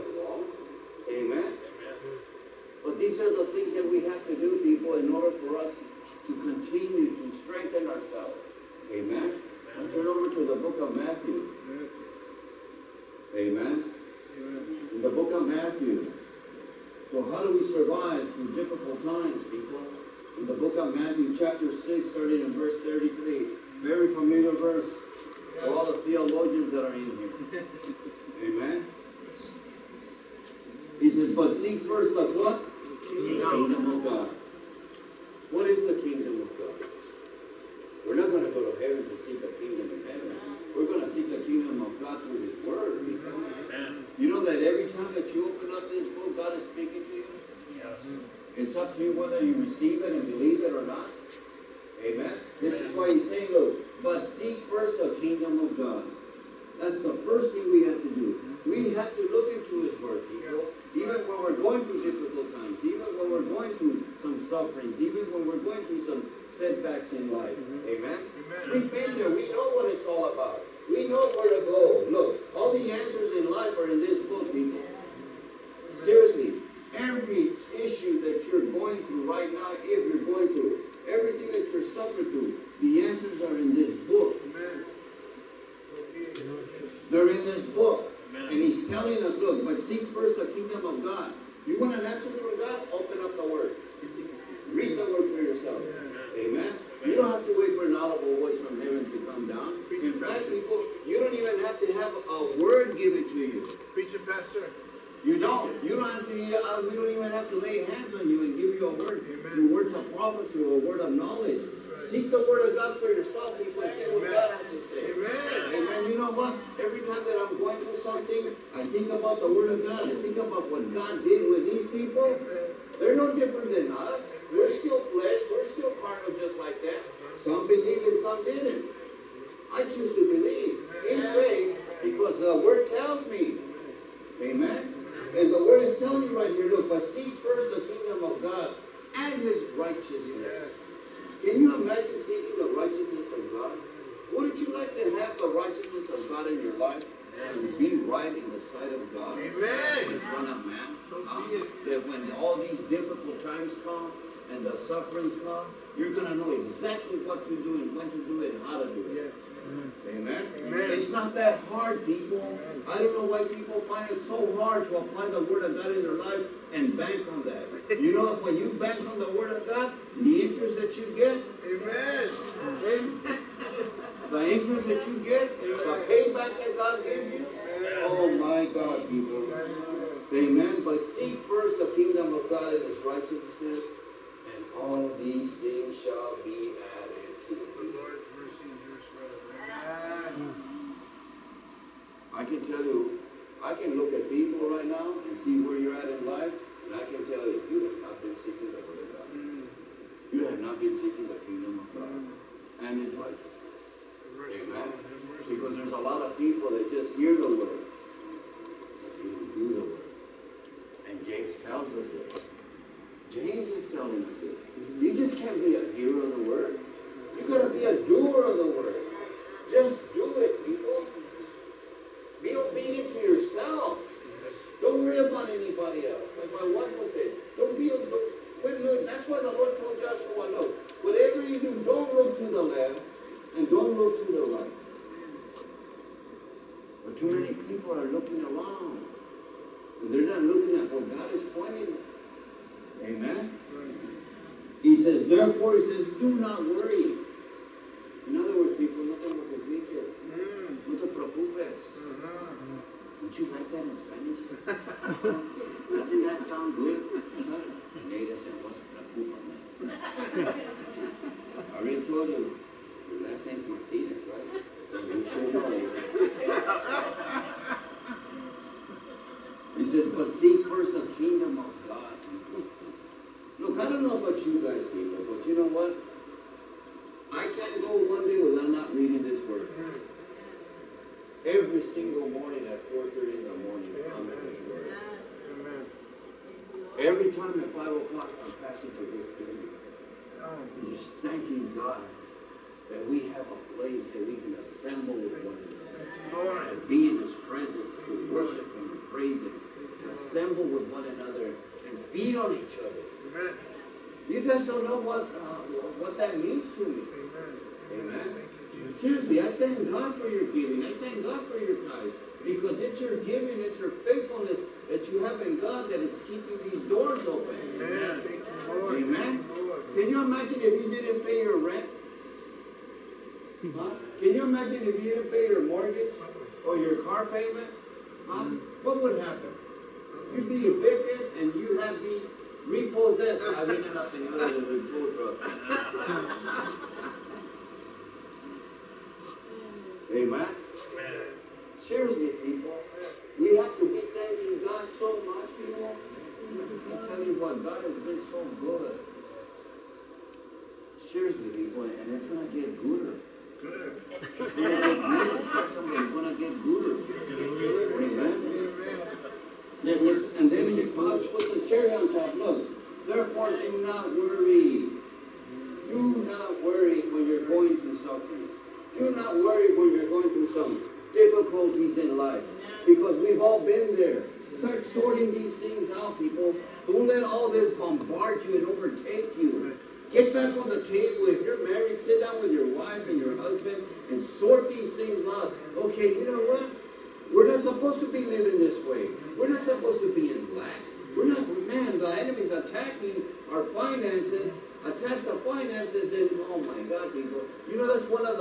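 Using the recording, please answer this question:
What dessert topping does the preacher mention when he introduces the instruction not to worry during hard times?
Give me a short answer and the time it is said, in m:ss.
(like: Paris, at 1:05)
cherry, at 6:01.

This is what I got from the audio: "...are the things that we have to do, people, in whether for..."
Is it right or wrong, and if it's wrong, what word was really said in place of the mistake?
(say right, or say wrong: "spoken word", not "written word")
wrong: "order", not "whether".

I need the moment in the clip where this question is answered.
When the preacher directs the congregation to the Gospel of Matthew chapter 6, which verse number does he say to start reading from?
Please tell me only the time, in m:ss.
0:22.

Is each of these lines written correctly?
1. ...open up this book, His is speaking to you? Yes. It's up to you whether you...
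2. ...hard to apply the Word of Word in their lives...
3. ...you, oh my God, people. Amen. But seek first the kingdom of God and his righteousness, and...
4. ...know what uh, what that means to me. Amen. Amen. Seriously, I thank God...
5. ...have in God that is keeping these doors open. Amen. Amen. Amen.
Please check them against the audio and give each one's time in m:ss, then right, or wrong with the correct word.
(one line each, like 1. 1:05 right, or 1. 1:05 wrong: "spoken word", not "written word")
1. 0:45 wrong: "God", not "His"
2. 2:44 wrong: "God", not "Word"
3. 2:57 right
4. 5:04 right
5. 5:15 right.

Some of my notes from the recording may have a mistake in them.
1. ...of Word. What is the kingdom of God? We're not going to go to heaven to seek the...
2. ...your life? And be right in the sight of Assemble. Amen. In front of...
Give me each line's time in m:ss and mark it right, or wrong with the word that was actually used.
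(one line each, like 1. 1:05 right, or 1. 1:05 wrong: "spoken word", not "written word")
1. 0:33 wrong: "God", not "Word"
2. 2:26 wrong: "God", not "Assemble".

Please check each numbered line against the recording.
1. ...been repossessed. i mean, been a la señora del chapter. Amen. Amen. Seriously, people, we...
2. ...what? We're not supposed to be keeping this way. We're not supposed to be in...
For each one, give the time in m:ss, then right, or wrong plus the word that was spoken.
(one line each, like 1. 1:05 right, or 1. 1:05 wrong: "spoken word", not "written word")
1. 5:32 wrong: "reporter", not "chapter"
2. 6:26 wrong: "living", not "keeping".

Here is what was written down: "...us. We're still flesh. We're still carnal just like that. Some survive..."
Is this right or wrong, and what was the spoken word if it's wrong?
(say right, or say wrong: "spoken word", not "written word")
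wrong: "believe", not "survive".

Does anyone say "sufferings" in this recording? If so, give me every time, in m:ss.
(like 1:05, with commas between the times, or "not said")
1:04, 2:34, 6:07.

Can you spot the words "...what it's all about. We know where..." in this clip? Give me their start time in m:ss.
1:09.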